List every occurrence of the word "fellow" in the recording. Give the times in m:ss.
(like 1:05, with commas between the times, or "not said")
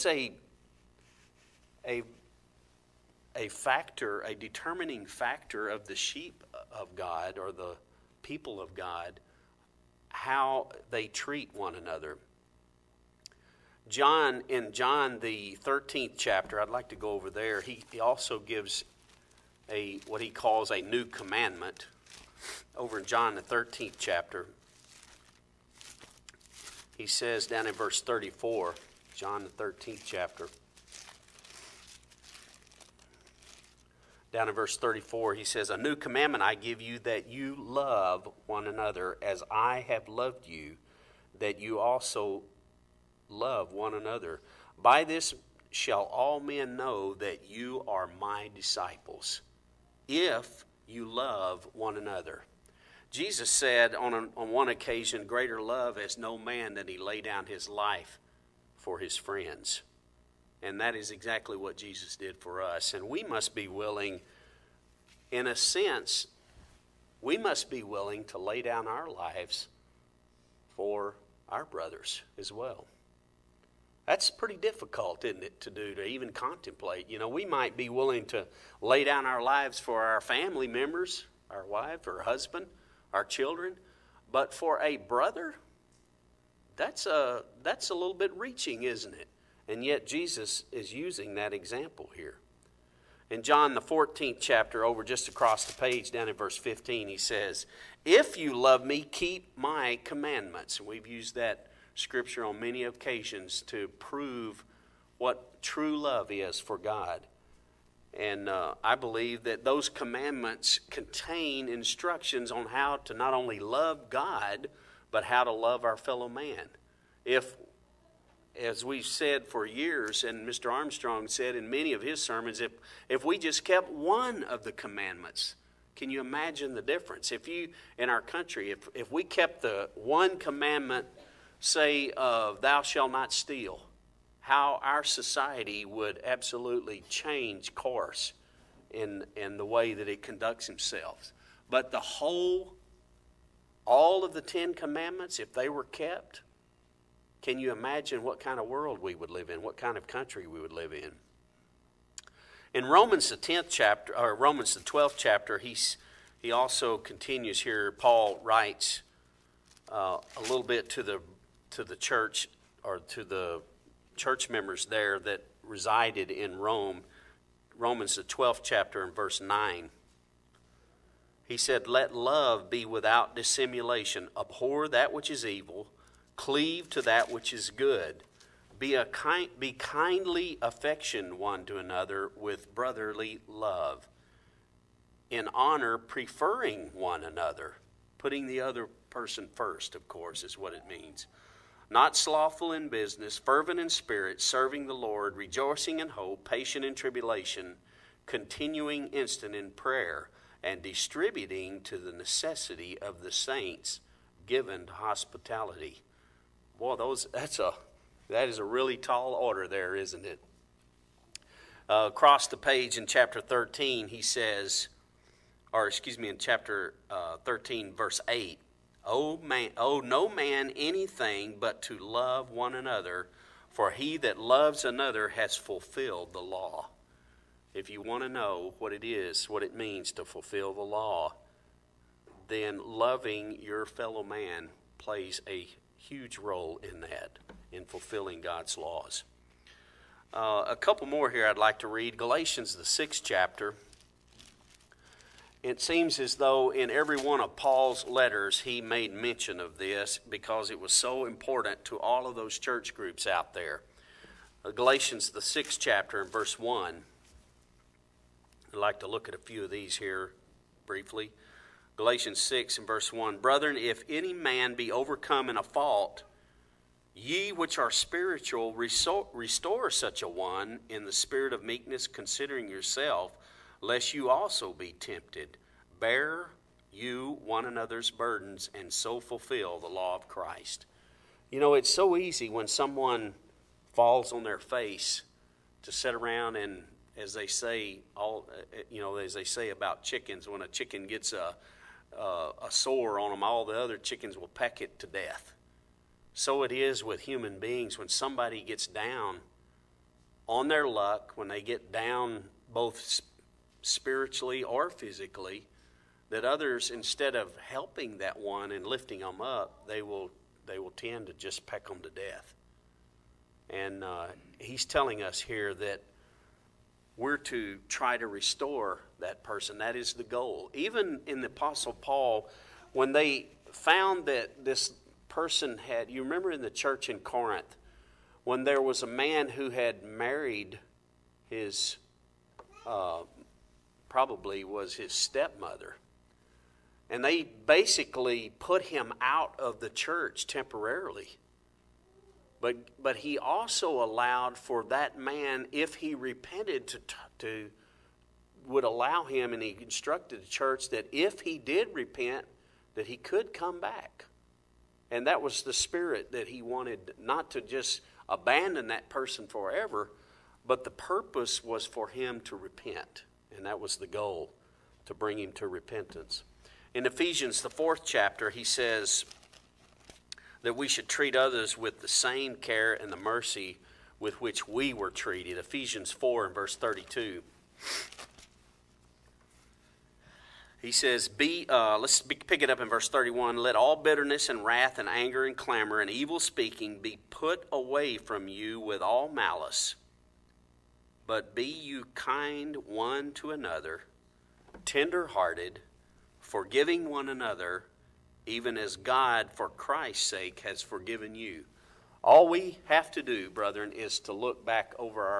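1:55, 3:53.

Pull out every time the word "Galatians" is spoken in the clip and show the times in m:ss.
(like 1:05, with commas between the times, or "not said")
4:02, 4:14, 4:21.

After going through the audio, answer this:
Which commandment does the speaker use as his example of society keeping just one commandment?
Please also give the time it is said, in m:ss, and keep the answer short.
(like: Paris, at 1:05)
Thou shalt not steal, at 2:12.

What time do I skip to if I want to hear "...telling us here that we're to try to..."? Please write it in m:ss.
5:14.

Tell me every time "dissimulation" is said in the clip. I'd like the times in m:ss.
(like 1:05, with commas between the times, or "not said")
2:53.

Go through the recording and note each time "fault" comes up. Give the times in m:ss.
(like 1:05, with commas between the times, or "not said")
4:25.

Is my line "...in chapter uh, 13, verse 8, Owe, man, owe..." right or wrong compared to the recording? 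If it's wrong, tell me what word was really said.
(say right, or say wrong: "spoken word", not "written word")
right.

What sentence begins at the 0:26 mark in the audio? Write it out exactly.
He says down in verse 34, John the 13th chapter.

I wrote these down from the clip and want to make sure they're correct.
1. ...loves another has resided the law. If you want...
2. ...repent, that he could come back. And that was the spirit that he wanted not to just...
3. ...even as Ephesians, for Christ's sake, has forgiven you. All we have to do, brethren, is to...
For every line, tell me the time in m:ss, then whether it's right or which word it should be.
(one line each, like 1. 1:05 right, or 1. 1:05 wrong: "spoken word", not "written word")
1. 3:44 wrong: "fulfilled", not "resided"
2. 5:51 right
3. 6:38 wrong: "God", not "Ephesians".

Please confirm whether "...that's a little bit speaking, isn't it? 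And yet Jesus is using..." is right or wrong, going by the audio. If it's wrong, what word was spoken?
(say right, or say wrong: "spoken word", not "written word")
wrong: "reaching", not "speaking".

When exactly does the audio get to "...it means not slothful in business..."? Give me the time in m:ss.
3:10.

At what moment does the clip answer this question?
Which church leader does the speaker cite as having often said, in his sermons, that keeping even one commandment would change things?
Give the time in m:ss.
2:00.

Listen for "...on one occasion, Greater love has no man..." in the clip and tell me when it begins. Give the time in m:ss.
0:54.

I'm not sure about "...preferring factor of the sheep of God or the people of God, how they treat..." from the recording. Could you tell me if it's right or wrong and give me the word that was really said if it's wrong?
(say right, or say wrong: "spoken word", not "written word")
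wrong: "determining", not "preferring".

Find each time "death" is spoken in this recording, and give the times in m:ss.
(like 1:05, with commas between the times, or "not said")
4:55, 5:12.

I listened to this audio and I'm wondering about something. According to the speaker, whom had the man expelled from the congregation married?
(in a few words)
His stepmother.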